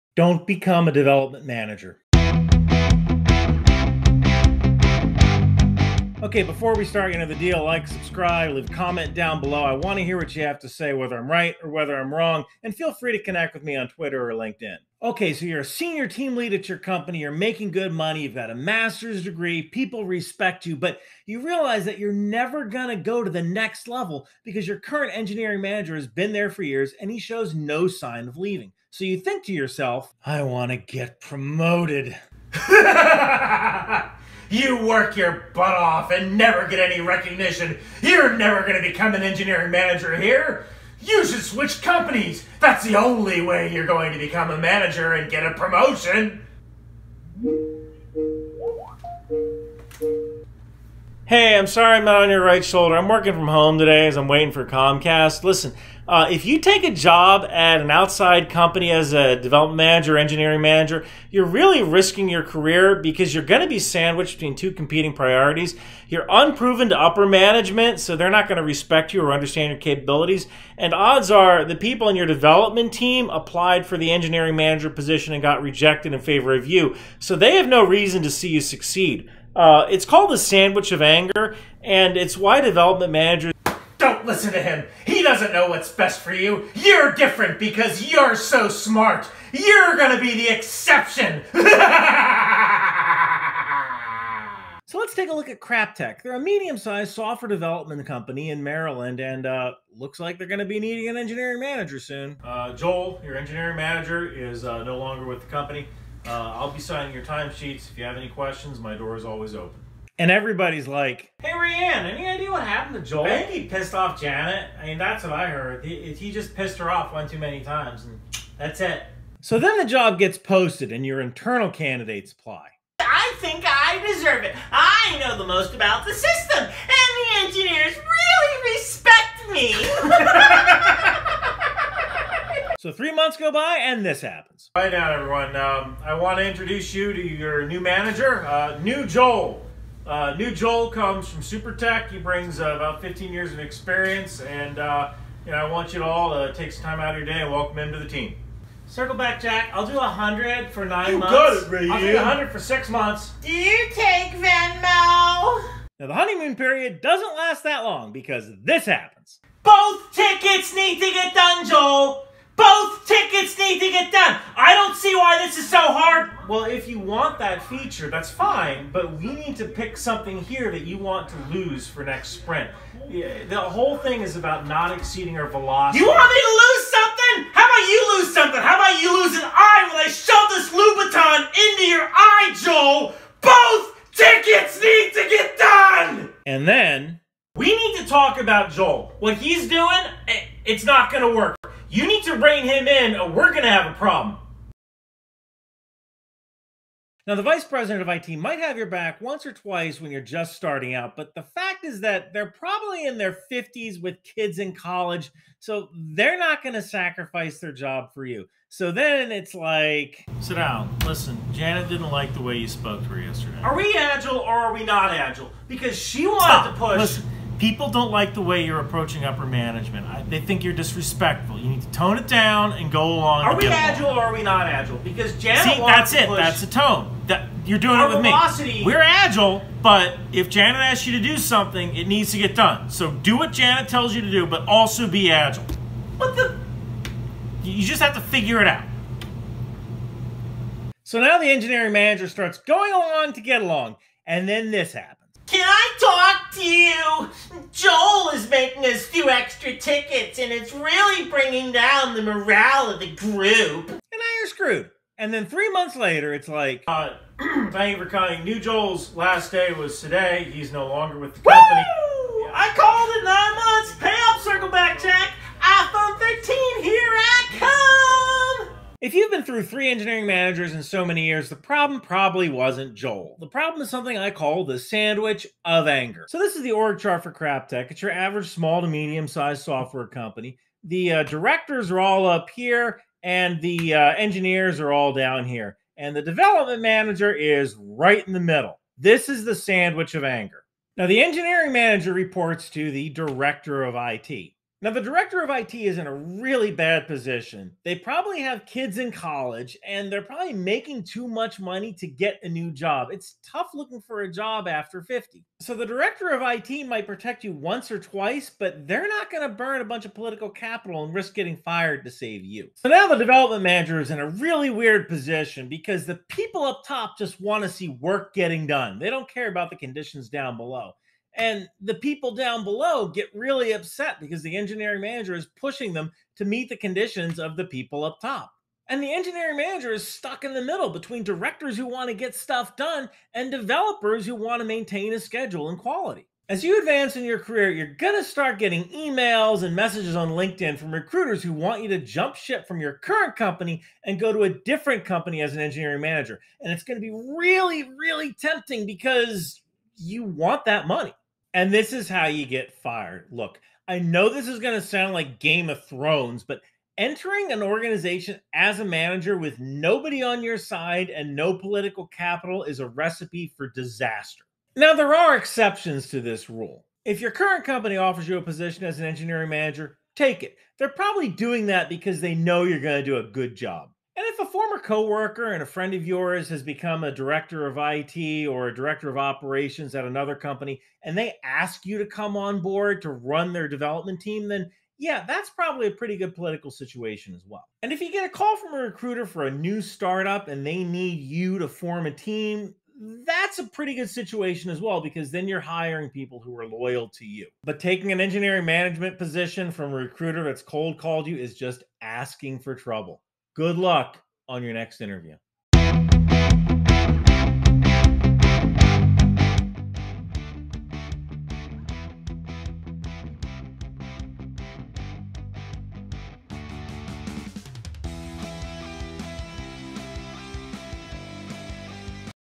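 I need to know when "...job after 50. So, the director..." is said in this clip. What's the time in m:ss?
5:04.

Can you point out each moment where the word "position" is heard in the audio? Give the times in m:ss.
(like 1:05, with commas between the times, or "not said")
1:14, 4:57, 5:15, 6:08, 6:39.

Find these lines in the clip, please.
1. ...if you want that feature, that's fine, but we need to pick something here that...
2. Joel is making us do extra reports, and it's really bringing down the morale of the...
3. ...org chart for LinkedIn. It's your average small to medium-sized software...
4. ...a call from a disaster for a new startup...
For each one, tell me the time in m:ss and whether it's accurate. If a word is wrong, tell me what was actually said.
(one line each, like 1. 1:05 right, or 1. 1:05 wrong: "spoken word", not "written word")
1. 2:46 right
2. 4:07 wrong: "tickets", not "reports"
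3. 4:36 wrong: "CrapTech", not "LinkedIn"
4. 6:28 wrong: "recruiter", not "disaster".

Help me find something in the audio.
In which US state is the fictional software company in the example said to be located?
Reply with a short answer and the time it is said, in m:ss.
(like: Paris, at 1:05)
Maryland, at 1:38.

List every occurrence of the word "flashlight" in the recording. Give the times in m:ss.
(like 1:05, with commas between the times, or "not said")
not said.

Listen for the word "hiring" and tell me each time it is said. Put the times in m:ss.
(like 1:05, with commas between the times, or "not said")
6:35.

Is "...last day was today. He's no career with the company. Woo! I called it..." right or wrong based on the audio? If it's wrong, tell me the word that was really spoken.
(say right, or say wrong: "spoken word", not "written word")
wrong: "longer", not "career".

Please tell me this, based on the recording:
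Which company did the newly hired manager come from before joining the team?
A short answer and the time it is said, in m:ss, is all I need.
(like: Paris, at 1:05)
SuperTech, at 2:21.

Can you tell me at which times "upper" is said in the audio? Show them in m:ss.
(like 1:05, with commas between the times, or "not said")
1:06, 3:39.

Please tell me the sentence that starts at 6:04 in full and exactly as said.
Now, there are exceptions to this rule.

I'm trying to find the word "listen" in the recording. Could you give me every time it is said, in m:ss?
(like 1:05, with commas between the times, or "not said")
0:55, 1:24, 3:31, 3:36.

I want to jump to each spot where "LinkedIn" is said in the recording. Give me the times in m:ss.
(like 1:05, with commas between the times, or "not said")
0:14, 5:40.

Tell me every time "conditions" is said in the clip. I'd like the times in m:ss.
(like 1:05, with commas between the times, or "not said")
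5:19, 5:26.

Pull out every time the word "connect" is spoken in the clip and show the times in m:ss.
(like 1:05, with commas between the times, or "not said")
0:13.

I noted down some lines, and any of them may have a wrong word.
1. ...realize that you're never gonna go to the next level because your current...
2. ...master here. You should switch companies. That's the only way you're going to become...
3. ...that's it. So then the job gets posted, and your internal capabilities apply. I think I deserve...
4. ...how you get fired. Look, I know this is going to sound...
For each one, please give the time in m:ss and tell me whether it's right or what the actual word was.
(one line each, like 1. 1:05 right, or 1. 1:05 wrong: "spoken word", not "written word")
1. 0:21 right
2. 0:39 wrong: "manager", not "master"
3. 1:58 wrong: "candidates", not "capabilities"
4. 5:52 right.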